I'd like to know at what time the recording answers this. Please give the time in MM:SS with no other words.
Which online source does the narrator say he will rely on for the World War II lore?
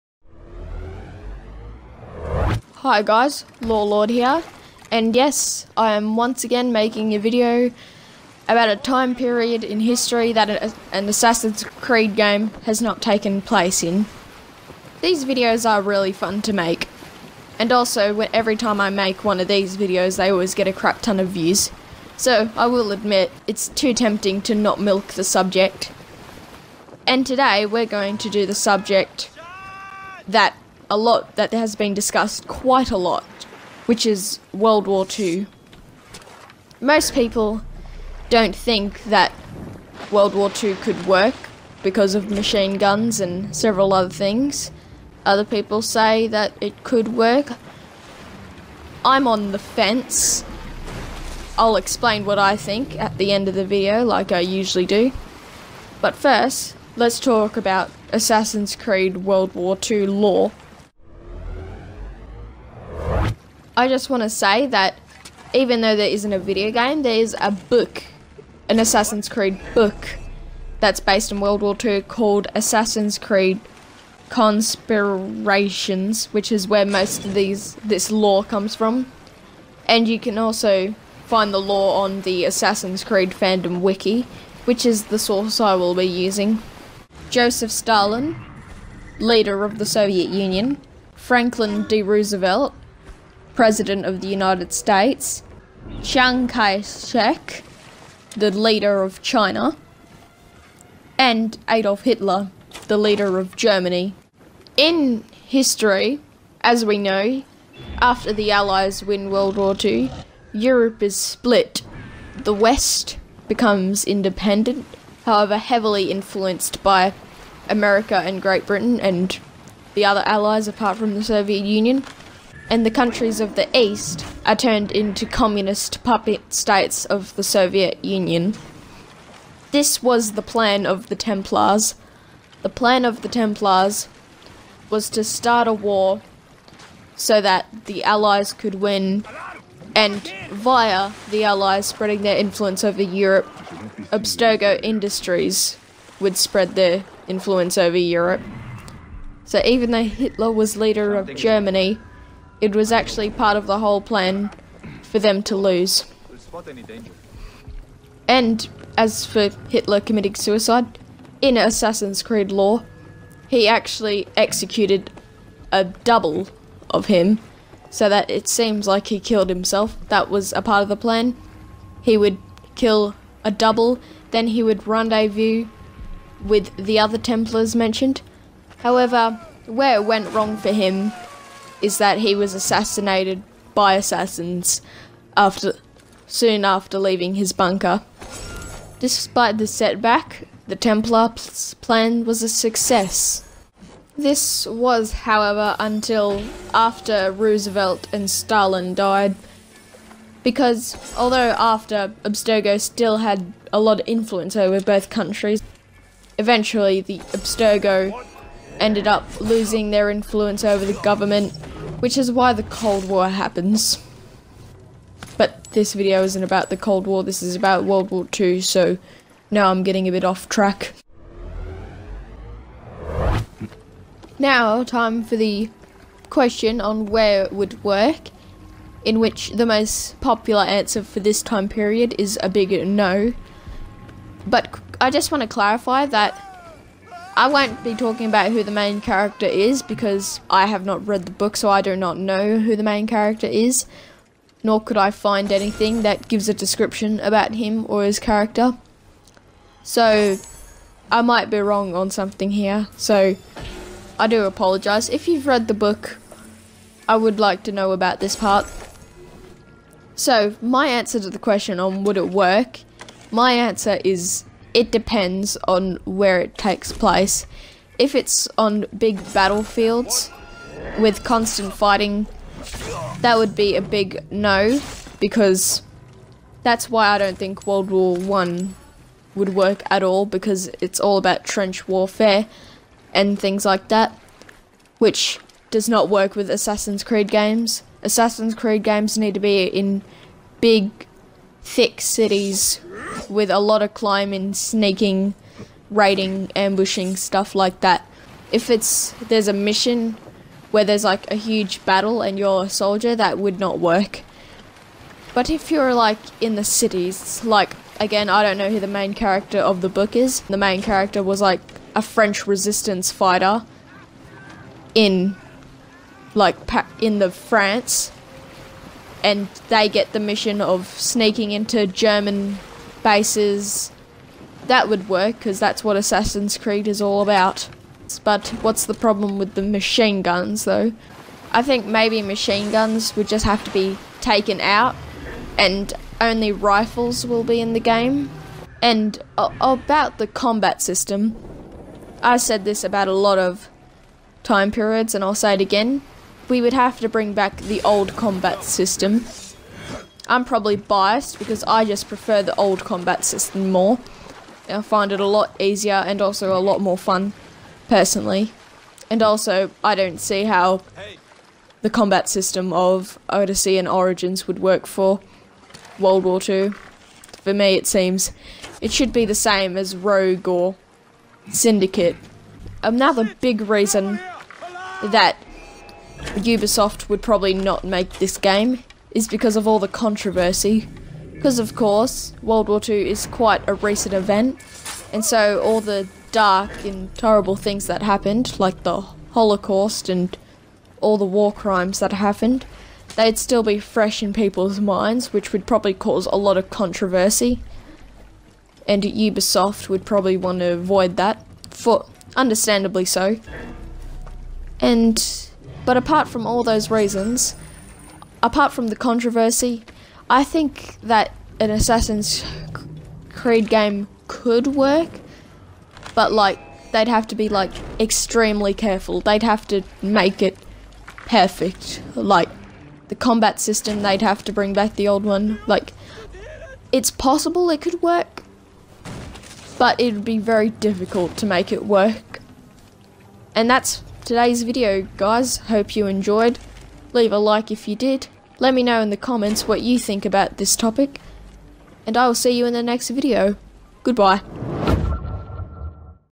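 01:22.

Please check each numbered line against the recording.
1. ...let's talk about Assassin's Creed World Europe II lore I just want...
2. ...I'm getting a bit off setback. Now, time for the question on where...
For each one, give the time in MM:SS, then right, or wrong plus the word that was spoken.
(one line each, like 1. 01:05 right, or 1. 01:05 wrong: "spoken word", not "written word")
1. 00:56 wrong: "War", not "Europe"
2. 03:39 wrong: "track", not "setback".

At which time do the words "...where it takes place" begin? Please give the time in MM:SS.
04:26.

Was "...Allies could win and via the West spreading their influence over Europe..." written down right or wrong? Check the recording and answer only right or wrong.
wrong.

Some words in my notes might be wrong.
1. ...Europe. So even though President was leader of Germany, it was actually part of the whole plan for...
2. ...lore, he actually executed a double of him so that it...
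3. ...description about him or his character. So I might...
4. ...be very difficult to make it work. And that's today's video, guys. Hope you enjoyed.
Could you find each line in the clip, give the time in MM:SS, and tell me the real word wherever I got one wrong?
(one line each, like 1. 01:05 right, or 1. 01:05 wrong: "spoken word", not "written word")
1. 02:27 wrong: "Hitler", not "President"
2. 02:42 right
3. 04:06 right
4. 07:10 right.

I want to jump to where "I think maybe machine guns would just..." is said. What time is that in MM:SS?
05:31.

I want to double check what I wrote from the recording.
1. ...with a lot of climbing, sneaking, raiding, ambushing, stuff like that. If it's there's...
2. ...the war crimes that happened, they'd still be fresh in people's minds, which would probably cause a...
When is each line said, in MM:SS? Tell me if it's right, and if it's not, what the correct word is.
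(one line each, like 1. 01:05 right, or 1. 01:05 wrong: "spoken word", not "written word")
1. 04:53 right
2. 06:31 right.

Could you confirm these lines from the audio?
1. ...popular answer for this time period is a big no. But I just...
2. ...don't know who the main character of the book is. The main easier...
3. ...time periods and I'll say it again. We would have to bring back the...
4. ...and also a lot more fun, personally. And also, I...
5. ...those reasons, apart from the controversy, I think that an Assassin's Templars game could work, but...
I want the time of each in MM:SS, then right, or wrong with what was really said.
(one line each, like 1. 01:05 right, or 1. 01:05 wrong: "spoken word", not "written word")
1. 03:50 right
2. 05:08 wrong: "character", not "easier"
3. 05:44 right
4. 05:56 right
5. 06:46 wrong: "Creed", not "Templars".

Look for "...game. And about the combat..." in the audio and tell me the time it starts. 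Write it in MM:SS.
05:37.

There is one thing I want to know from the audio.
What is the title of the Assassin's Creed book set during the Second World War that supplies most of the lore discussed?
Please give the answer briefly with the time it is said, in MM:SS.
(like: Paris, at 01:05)
Assassin's Creed Conspirations, at 01:12.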